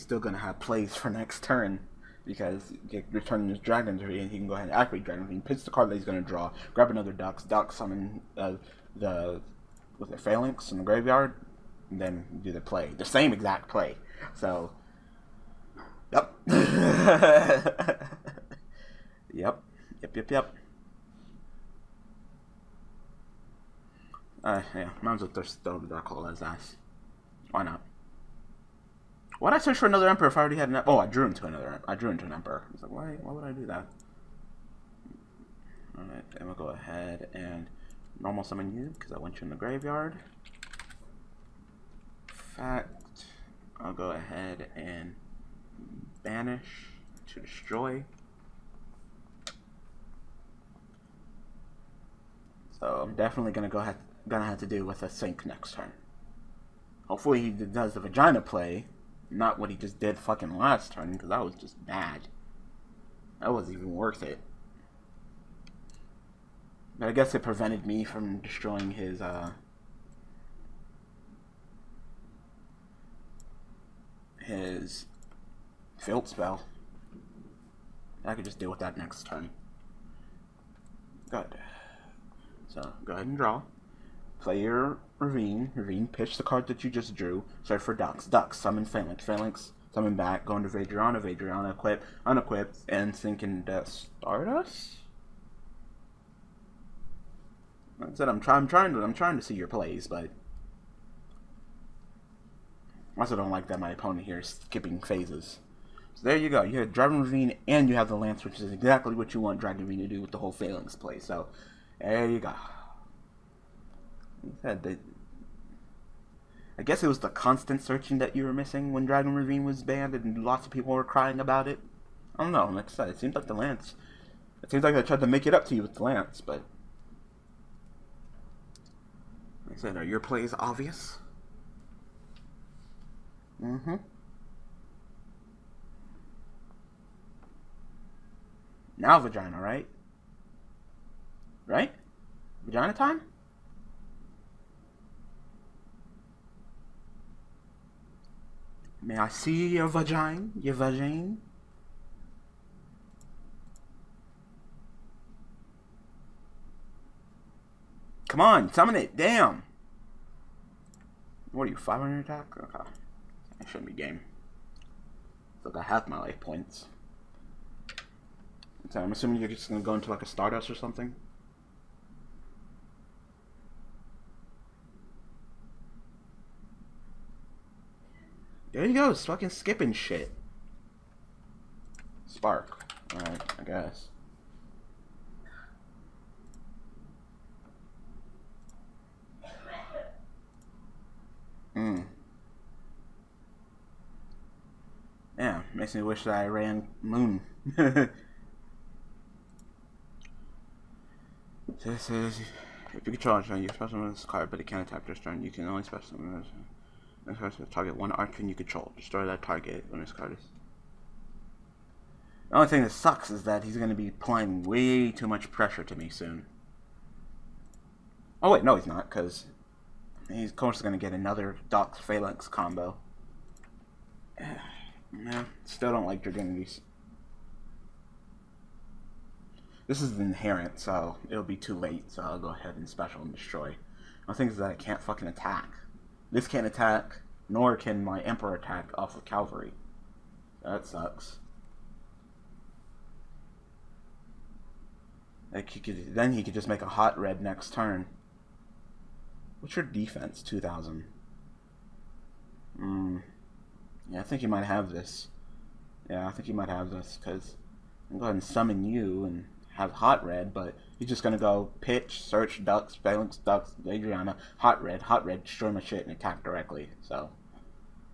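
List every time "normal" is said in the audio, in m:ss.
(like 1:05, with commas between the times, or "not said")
0:38.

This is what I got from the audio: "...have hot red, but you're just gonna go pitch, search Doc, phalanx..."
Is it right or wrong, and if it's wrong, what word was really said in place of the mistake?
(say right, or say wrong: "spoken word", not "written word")
wrong: "Dux", not "Doc".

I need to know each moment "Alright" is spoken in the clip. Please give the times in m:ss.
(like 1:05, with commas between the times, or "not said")
0:35, 3:03.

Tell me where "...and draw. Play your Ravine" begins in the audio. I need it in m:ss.
1:23.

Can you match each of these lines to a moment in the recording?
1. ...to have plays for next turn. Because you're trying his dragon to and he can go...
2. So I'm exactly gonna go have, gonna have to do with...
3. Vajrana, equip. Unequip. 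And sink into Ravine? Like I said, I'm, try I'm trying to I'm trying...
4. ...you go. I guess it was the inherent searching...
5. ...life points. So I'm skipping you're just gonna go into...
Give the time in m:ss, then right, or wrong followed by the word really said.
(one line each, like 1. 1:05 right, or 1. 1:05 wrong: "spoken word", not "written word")
1. 0:00 wrong: "turning", not "trying"
2. 0:52 wrong: "definitely", not "exactly"
3. 1:31 wrong: "Stardust", not "Ravine"
4. 1:52 wrong: "constant", not "inherent"
5. 2:46 wrong: "assuming", not "skipping".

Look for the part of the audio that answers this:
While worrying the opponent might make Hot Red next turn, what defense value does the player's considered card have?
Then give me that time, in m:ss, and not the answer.
4:10.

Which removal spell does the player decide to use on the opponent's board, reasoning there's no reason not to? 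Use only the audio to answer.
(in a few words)
Dark Hole.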